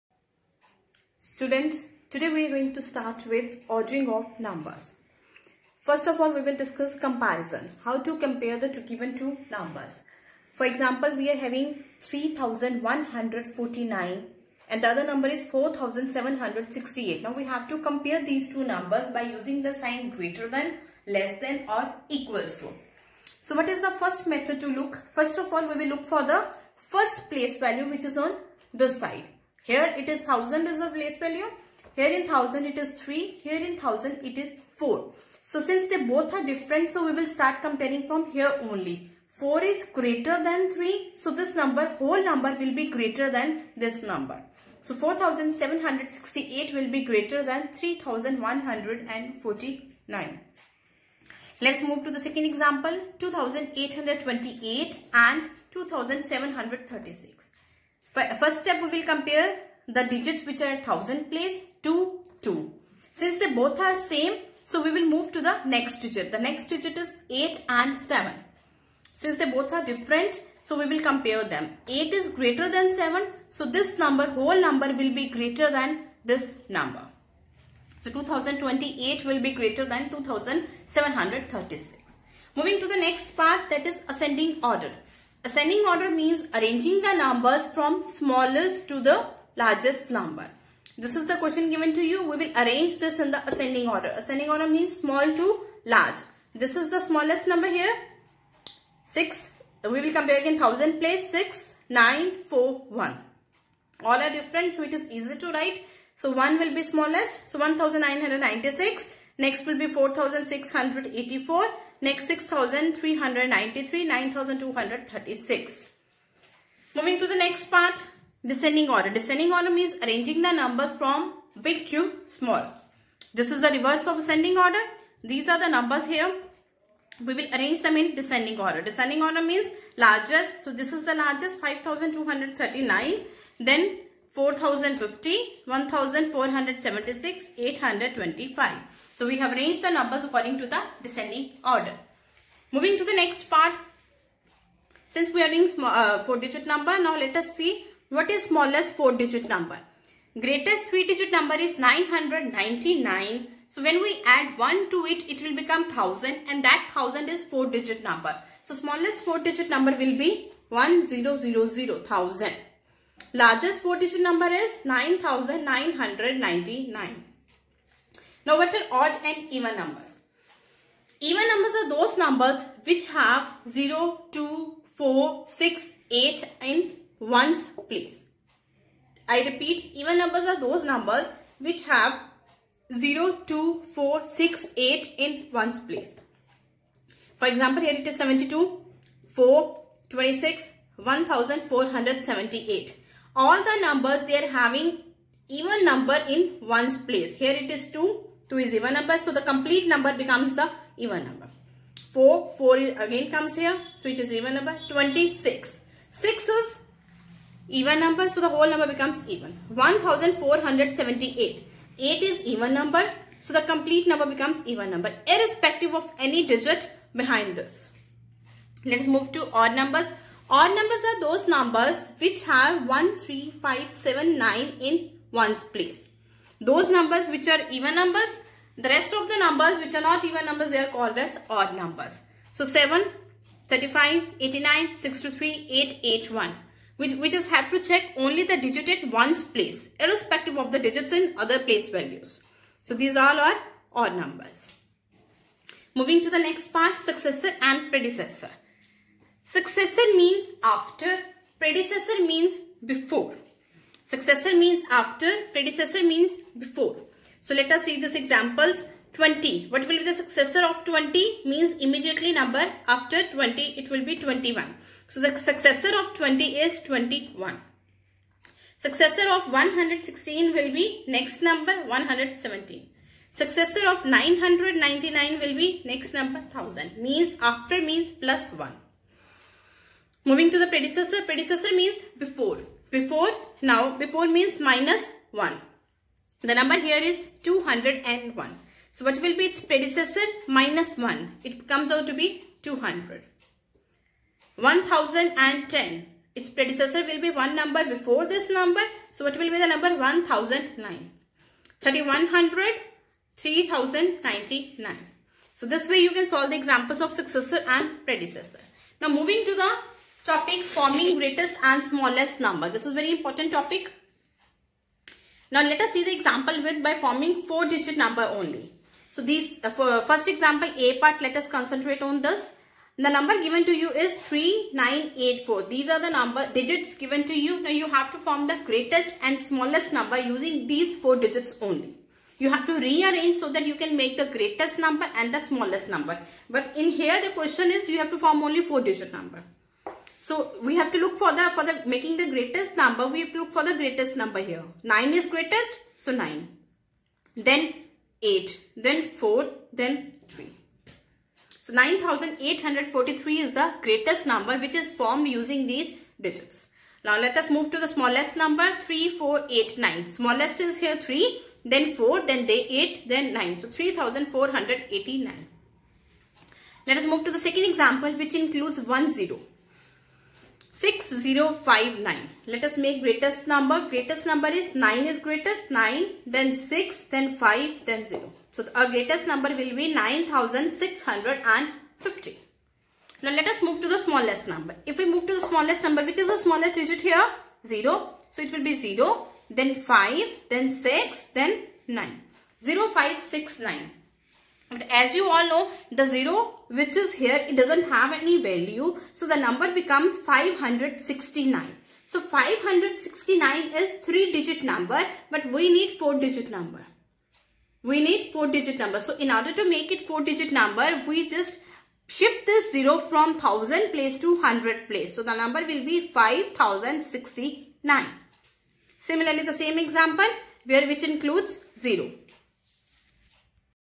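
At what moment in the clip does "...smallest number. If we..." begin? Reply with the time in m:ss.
6:23.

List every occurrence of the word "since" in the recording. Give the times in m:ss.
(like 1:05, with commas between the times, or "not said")
0:35, 1:03, 1:09, 2:25.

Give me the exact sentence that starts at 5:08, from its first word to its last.
Now moving to the topic forming greatest and smallest number.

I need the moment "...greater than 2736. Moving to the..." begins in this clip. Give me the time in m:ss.
1:19.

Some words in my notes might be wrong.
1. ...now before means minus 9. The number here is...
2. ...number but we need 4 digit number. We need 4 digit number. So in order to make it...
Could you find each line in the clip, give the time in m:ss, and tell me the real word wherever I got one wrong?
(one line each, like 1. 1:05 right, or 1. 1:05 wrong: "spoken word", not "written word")
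1. 4:43 wrong: "1", not "9"
2. 6:44 right.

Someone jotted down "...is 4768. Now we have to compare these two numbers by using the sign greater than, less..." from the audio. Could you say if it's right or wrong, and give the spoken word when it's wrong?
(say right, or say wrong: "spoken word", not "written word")
right.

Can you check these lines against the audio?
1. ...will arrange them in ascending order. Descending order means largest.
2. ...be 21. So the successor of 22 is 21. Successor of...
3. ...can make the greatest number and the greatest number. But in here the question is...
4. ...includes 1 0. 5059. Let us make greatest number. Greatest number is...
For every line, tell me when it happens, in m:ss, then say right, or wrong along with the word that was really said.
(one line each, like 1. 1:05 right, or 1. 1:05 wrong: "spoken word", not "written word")
1. 2:07 wrong: "descending", not "ascending"
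2. 4:24 wrong: "20", not "22"
3. 5:33 wrong: "smallest", not "greatest"
4. 6:08 wrong: "6059", not "5059".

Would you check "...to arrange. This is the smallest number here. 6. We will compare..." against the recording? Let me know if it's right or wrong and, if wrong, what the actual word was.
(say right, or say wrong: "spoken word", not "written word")
wrong: "large", not "arrange".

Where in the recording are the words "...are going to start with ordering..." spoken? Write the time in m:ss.
0:02.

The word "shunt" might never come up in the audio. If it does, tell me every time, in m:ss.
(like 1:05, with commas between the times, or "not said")
not said.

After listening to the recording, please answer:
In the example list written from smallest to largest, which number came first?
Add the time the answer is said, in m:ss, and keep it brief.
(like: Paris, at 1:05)
1996, at 1:47.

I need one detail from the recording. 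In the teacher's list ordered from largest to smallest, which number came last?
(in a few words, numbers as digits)
825.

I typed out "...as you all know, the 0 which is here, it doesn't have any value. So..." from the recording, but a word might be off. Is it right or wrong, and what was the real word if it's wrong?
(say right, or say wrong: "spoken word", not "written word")
right.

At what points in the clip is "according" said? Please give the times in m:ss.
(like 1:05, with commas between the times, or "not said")
2:20.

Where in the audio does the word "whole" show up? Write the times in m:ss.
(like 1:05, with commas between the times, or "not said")
0:41, 1:14, 3:28.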